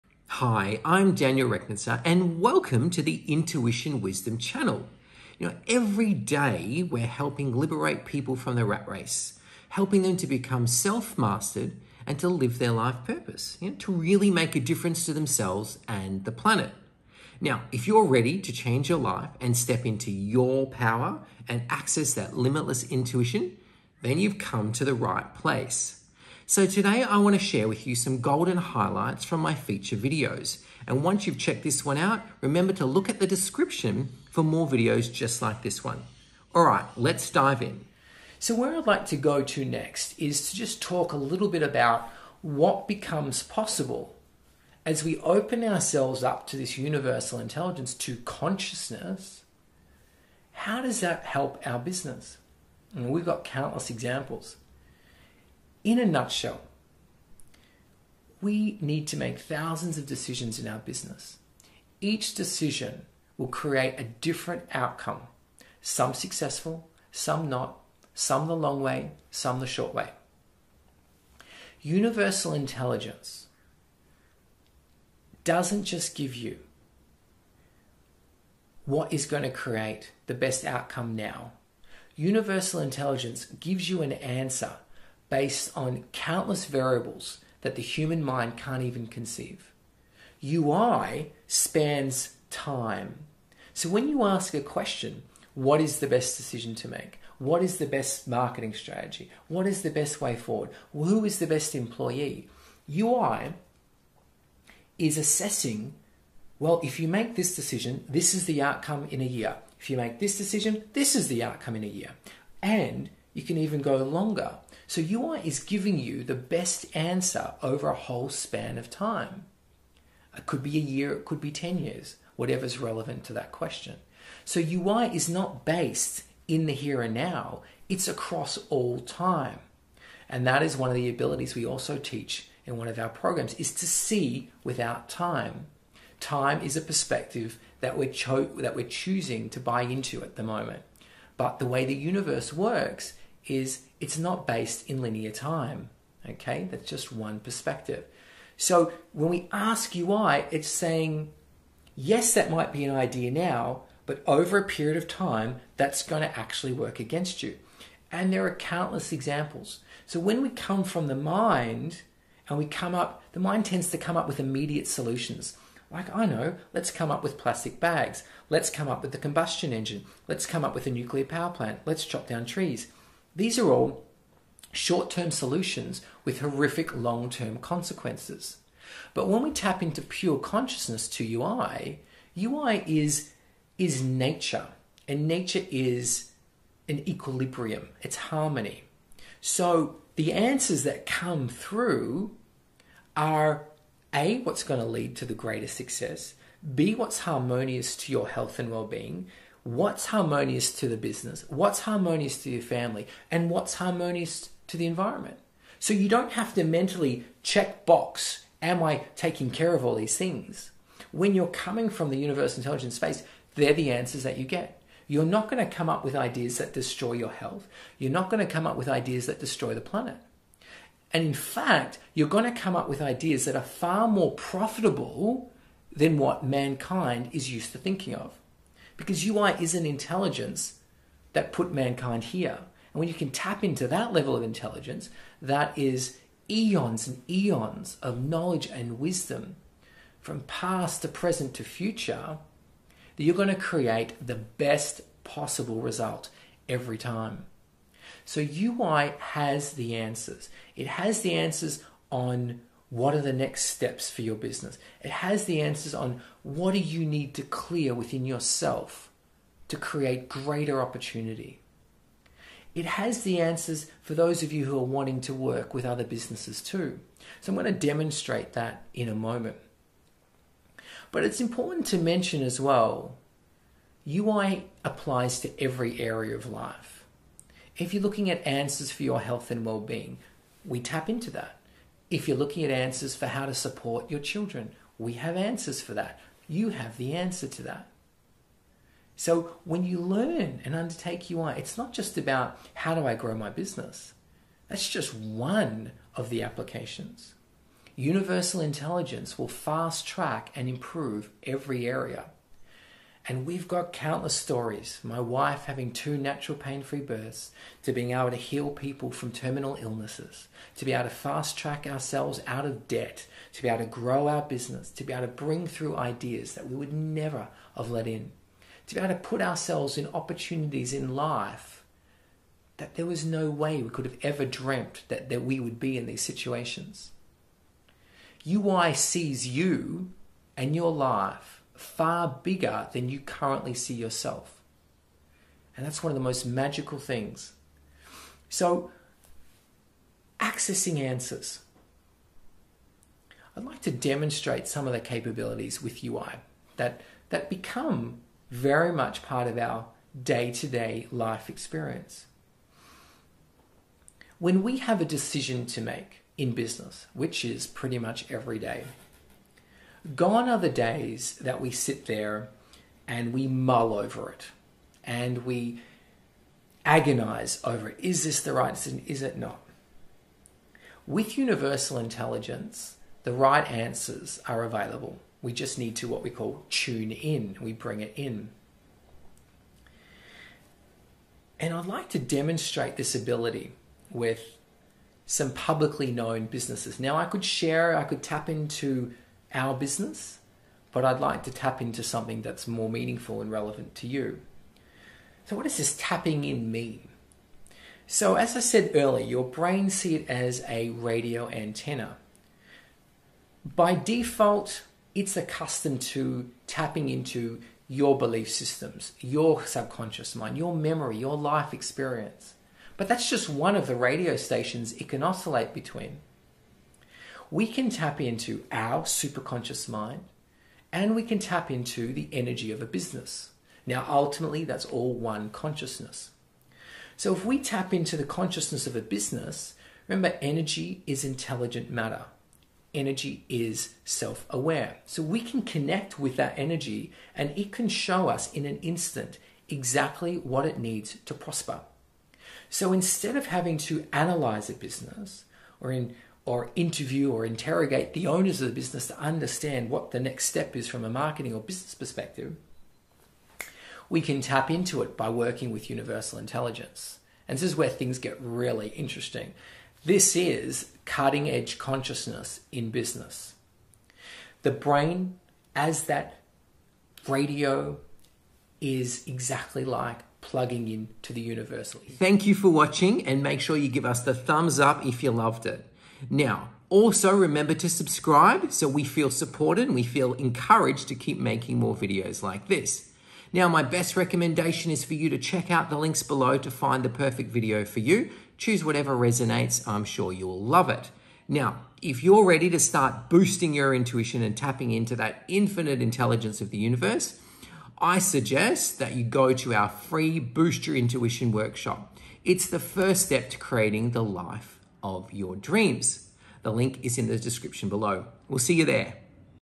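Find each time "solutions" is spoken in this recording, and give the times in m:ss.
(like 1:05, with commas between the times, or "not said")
2:44, 2:55.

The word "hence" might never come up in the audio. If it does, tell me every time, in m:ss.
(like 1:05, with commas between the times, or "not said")
not said.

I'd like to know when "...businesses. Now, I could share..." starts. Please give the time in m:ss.
6:26.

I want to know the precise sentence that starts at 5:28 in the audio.
UI sees you and your life far bigger than you currently see yourself.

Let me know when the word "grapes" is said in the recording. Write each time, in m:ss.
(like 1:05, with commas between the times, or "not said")
not said.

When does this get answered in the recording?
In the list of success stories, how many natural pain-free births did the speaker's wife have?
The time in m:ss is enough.
5:05.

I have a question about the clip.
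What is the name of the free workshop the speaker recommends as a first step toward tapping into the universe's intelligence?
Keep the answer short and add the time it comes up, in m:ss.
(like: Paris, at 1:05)
Boost Your Intuition, at 8:20.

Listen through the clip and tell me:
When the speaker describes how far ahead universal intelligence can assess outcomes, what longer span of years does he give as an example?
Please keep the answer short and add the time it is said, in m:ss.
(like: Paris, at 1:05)
10 years, at 2:01.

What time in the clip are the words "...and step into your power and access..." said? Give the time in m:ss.
0:19.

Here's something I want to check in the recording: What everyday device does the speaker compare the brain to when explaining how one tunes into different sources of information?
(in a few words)
Radio antenna.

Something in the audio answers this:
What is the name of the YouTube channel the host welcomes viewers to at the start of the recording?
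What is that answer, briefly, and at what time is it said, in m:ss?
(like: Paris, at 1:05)
Intuition Wisdom, at 0:03.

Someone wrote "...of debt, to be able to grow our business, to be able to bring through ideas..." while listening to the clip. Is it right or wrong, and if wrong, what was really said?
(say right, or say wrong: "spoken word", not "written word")
right.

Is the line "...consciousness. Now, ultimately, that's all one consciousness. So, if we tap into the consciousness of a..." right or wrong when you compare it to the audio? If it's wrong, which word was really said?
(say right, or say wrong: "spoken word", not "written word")
wrong: "business", not "consciousness".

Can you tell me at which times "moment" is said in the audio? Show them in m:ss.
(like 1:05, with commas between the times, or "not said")
2:20, 4:29.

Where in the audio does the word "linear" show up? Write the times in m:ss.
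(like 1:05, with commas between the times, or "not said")
2:25.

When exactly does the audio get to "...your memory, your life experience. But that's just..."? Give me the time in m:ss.
6:50.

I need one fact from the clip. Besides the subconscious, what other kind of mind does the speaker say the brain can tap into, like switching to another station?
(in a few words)
Superconscious mind.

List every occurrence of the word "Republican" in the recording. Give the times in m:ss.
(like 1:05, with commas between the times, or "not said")
not said.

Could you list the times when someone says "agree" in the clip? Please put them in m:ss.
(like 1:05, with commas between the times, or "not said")
not said.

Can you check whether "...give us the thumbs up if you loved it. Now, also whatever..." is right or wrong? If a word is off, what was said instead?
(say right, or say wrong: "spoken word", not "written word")
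wrong: "remember", not "whatever".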